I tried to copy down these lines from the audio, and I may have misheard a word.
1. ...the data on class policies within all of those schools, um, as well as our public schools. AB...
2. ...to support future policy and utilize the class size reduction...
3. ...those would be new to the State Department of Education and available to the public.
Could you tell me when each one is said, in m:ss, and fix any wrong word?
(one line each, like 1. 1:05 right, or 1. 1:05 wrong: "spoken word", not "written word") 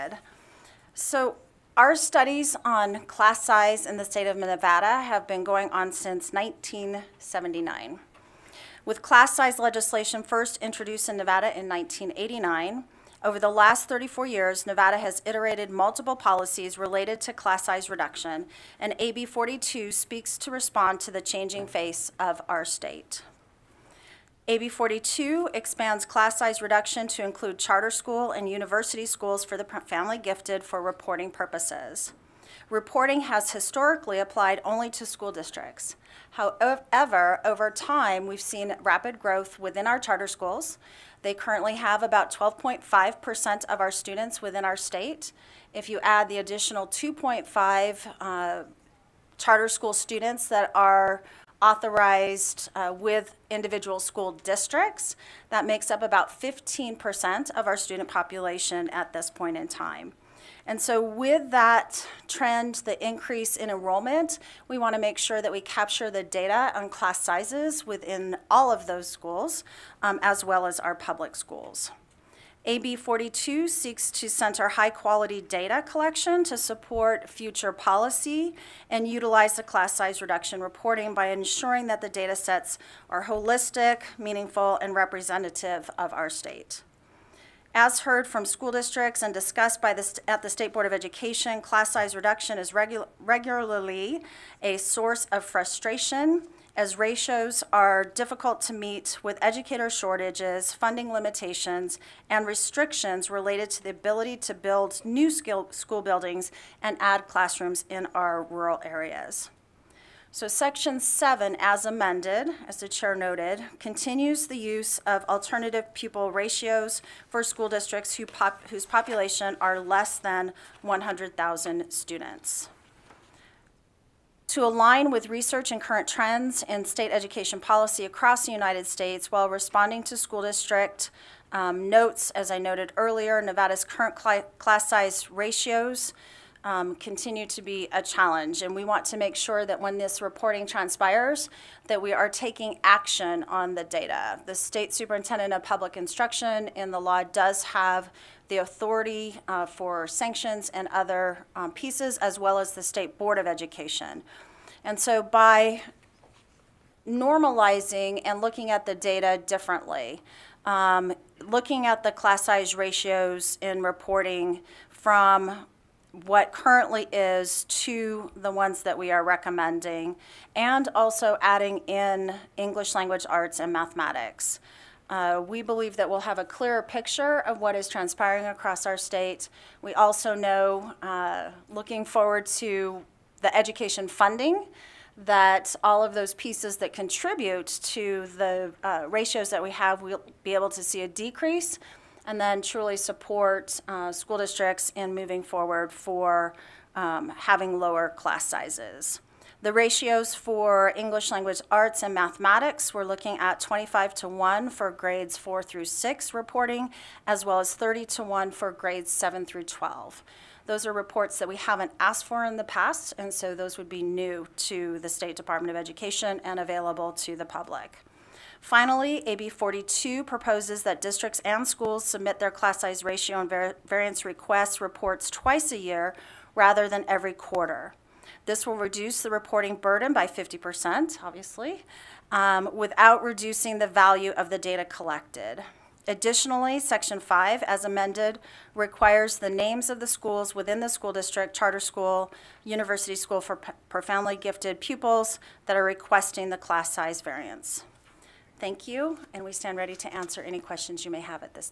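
1. 1:06 wrong: "sizes", not "policies"
2. 1:16 right
3. 3:33 right.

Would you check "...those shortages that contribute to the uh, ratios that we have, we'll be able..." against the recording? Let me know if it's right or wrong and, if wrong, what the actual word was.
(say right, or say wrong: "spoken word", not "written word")
wrong: "pieces", not "shortages".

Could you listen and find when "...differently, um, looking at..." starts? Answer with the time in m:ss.
2:39.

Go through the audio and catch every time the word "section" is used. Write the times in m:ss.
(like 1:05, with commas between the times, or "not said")
1:50, 3:56.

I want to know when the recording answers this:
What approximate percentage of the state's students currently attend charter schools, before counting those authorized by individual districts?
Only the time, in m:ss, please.
0:42.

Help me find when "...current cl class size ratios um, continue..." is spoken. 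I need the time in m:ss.
2:13.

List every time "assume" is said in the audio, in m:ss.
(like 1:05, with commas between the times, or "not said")
not said.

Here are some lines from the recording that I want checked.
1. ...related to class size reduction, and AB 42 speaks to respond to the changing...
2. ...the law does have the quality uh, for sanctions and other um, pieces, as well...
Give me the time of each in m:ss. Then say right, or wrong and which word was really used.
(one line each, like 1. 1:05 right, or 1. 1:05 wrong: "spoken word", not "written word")
1. 0:16 right
2. 2:26 wrong: "authority", not "quality".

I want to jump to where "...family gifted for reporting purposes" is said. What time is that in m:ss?
0:29.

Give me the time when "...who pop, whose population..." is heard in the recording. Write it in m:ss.
1:58.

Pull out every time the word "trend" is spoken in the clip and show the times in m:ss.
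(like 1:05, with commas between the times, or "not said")
1:02, 2:06.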